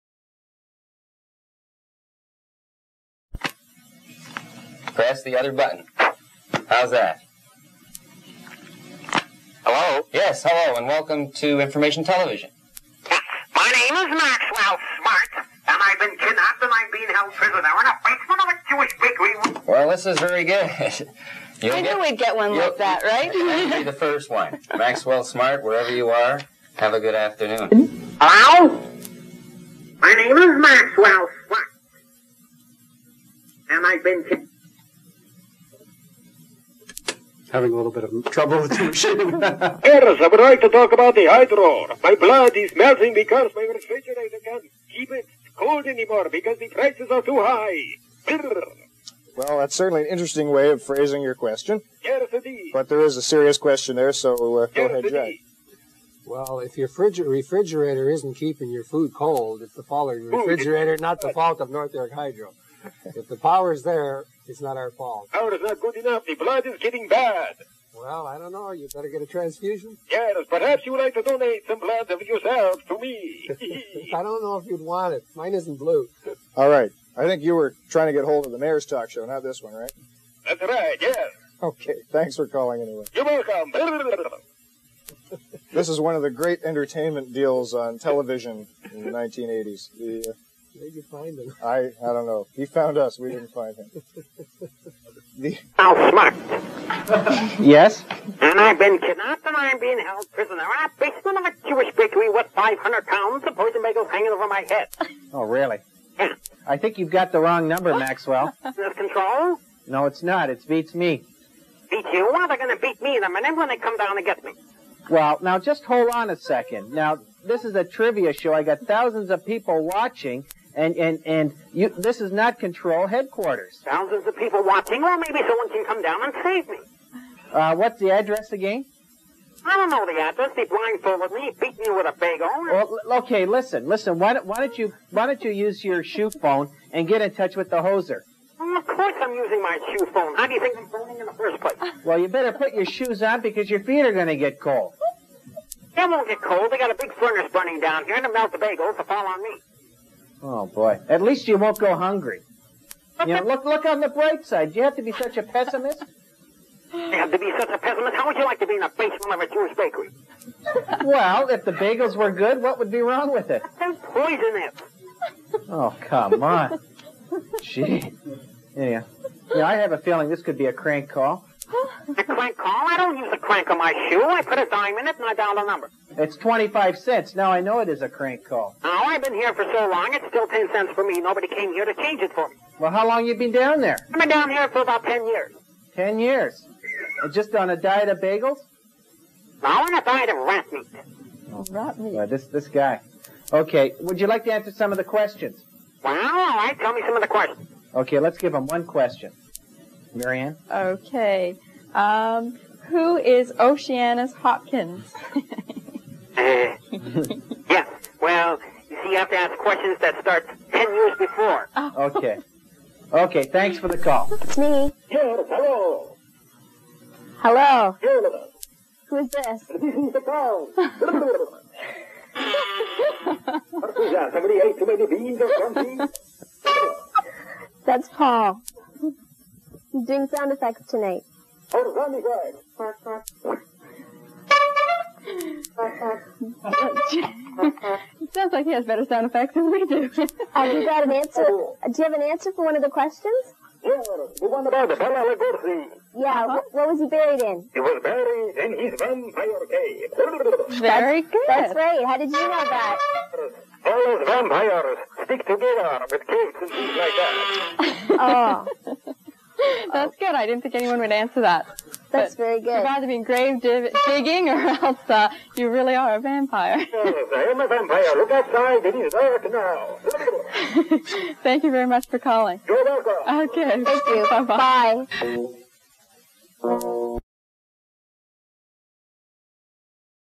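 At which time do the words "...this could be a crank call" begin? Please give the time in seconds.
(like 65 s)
170 s.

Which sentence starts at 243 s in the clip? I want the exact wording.
Yeah, the one about the Palalagosi.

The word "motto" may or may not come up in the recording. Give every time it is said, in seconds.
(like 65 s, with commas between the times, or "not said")
not said.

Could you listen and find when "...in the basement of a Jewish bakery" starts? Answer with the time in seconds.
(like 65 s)
158 s.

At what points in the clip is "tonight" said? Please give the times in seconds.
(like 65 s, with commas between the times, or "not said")
230 s.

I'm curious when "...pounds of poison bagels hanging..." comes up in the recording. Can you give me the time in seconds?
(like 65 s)
103 s.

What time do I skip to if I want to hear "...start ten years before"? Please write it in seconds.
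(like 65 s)
210 s.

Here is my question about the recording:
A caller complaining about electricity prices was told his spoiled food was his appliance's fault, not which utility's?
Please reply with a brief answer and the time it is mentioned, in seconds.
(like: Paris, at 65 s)
North York Hydro, at 61 s.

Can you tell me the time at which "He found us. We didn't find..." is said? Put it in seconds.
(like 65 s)
92 s.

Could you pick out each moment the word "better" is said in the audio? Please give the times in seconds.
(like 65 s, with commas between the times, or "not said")
68 s, 142 s, 238 s.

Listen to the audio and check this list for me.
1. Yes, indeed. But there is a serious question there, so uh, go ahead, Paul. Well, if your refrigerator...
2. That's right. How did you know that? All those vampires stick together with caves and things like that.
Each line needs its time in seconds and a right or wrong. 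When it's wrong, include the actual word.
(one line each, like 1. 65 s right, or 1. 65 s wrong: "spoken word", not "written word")
1. 52 s wrong: "Jack", not "Paul"
2. 251 s right.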